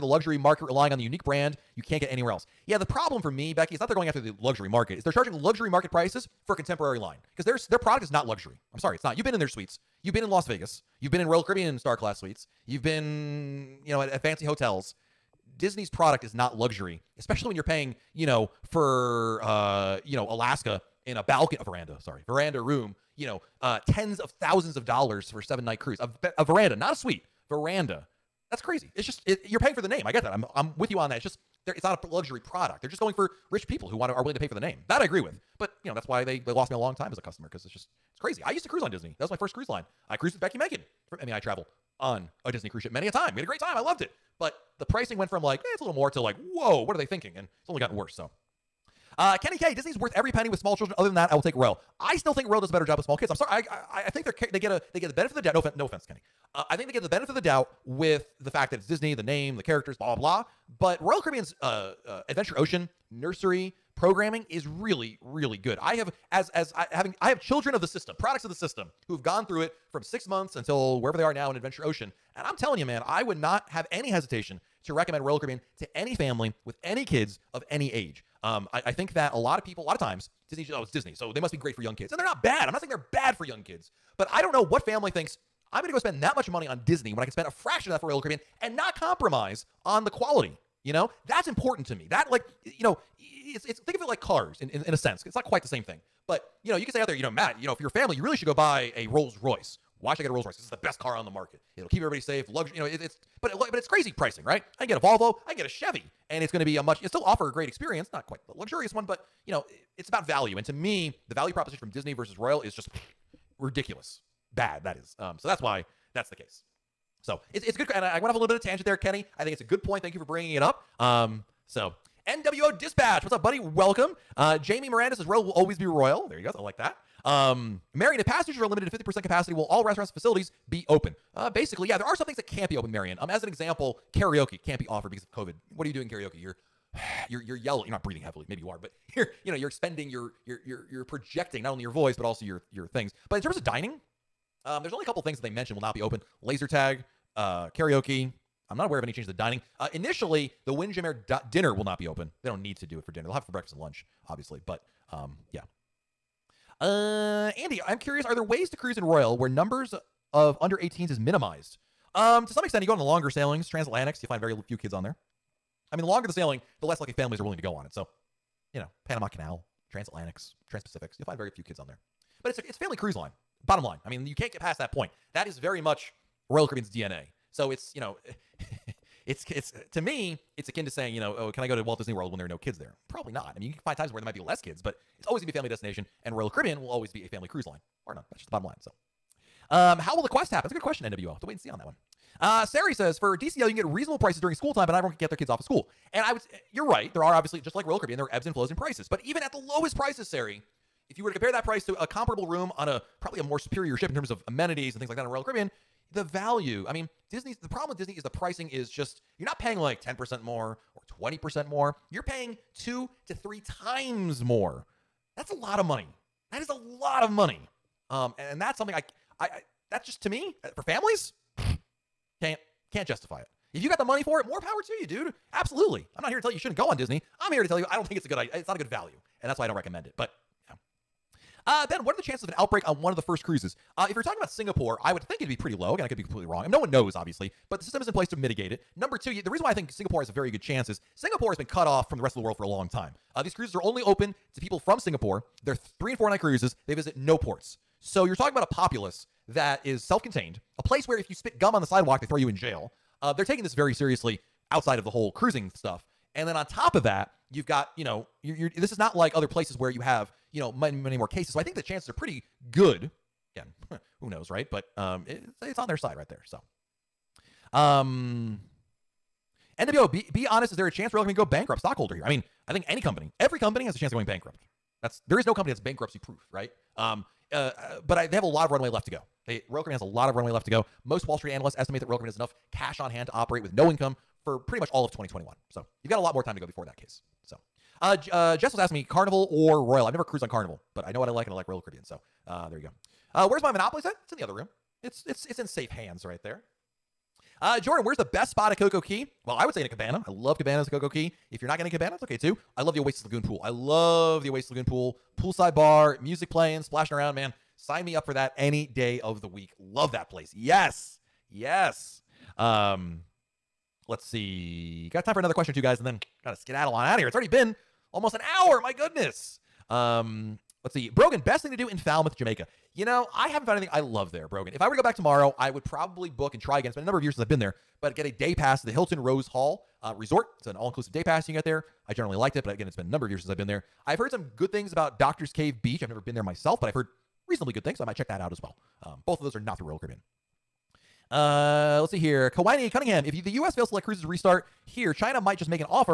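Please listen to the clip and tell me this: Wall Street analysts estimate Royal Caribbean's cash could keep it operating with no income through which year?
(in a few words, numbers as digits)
2021.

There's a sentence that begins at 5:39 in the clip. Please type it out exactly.
Um, both of those are not through Royal Caribbean.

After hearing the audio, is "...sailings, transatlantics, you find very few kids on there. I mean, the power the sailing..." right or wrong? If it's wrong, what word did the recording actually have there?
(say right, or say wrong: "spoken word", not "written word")
wrong: "longer", not "power".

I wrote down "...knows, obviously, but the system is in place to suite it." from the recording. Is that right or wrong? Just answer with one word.
wrong.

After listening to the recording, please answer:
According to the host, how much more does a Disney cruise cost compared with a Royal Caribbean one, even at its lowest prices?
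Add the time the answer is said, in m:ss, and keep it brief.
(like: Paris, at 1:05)
2 to 3 times more, at 3:32.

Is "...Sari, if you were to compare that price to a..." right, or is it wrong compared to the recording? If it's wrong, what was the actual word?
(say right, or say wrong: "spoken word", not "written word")
right.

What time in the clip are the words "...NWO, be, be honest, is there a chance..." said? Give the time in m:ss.
4:29.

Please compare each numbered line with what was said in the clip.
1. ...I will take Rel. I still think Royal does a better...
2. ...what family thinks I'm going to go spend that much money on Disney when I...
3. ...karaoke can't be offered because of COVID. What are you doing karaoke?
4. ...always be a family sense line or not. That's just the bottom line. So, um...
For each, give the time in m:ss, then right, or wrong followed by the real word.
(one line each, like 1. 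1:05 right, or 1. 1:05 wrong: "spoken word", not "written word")
1. 0:51 right
2. 1:24 right
3. 2:14 right
4. 3:06 wrong: "cruise", not "sense".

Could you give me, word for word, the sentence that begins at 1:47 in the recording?
It still offer a great experience, not quite the luxurious one, but you know, it's about value.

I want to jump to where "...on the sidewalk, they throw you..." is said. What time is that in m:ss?
4:11.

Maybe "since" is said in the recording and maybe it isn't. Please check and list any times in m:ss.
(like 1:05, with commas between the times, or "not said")
5:27, 5:33.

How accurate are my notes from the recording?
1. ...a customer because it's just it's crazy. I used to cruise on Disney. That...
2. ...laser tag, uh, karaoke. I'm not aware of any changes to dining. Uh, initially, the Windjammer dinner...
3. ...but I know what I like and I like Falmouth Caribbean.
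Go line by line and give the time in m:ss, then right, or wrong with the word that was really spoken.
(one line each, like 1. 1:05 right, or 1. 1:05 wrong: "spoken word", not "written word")
1. 0:37 right
2. 2:26 right
3. 4:50 wrong: "Royal", not "Falmouth".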